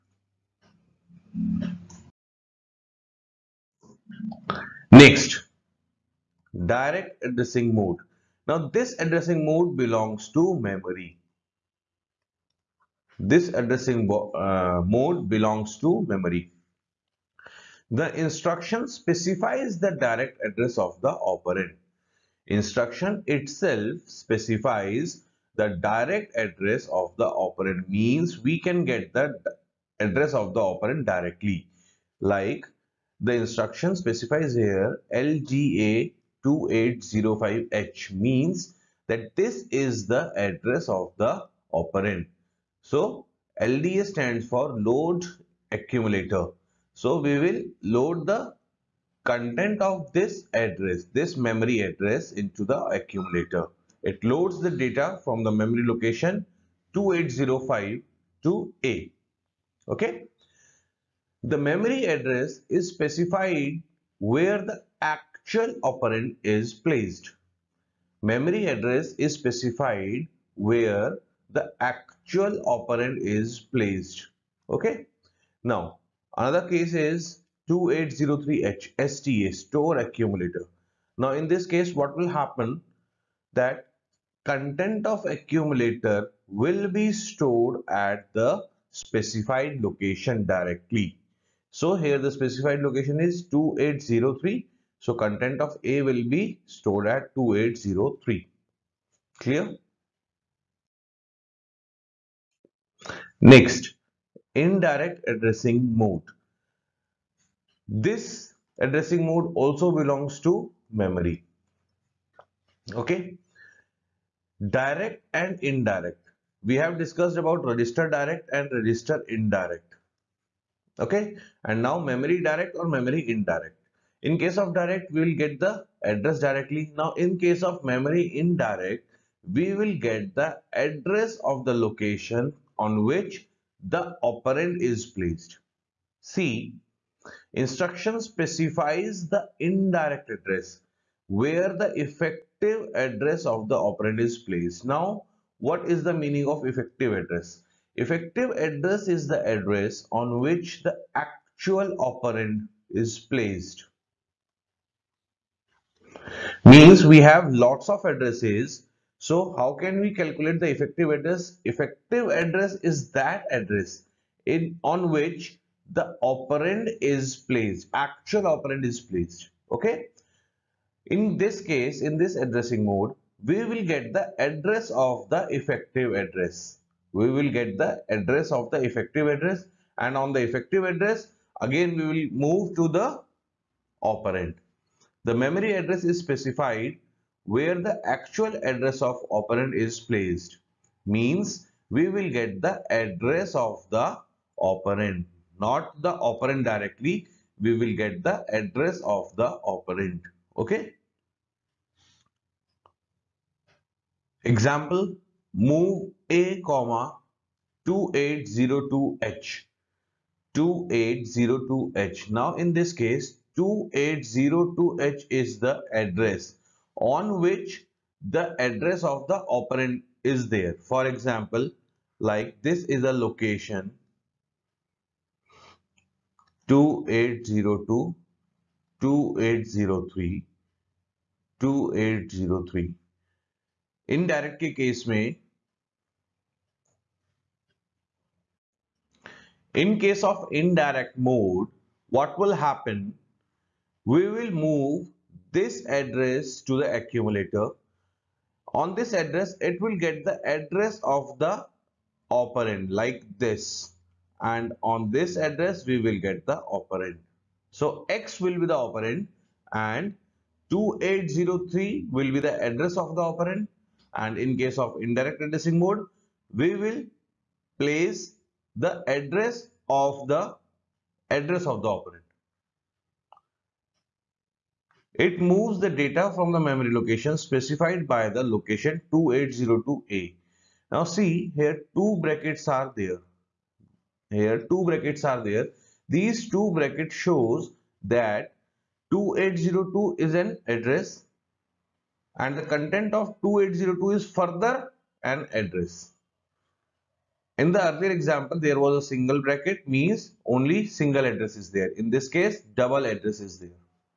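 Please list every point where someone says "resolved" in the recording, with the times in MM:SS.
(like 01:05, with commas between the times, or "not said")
not said.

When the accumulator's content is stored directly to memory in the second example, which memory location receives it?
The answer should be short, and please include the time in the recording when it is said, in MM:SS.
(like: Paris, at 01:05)
2803H, at 01:17.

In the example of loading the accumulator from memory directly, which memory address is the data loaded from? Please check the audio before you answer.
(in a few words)
2805H.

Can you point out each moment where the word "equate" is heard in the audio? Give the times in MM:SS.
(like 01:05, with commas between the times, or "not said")
not said.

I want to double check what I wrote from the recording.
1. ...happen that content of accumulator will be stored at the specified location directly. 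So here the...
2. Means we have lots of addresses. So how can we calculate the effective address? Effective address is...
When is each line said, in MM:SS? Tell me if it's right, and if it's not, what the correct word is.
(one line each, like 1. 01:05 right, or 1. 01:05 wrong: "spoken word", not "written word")
1. 01:22 right
2. 02:36 right.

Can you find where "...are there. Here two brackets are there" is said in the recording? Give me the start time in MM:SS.
04:42.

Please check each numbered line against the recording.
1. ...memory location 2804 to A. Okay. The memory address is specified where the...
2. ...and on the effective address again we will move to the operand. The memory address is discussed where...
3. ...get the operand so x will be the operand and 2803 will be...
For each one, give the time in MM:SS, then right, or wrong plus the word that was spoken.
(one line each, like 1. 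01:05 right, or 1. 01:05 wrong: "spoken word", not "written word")
1. 00:55 wrong: "2805", not "2804"
2. 02:59 wrong: "specified", not "discussed"
3. 04:16 right.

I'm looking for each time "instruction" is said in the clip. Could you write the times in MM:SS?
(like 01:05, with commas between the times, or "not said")
00:18, 00:22, 00:33, 02:17.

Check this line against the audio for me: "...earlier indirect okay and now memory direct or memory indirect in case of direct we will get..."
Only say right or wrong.
wrong.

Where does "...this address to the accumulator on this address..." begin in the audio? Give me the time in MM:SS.
04:05.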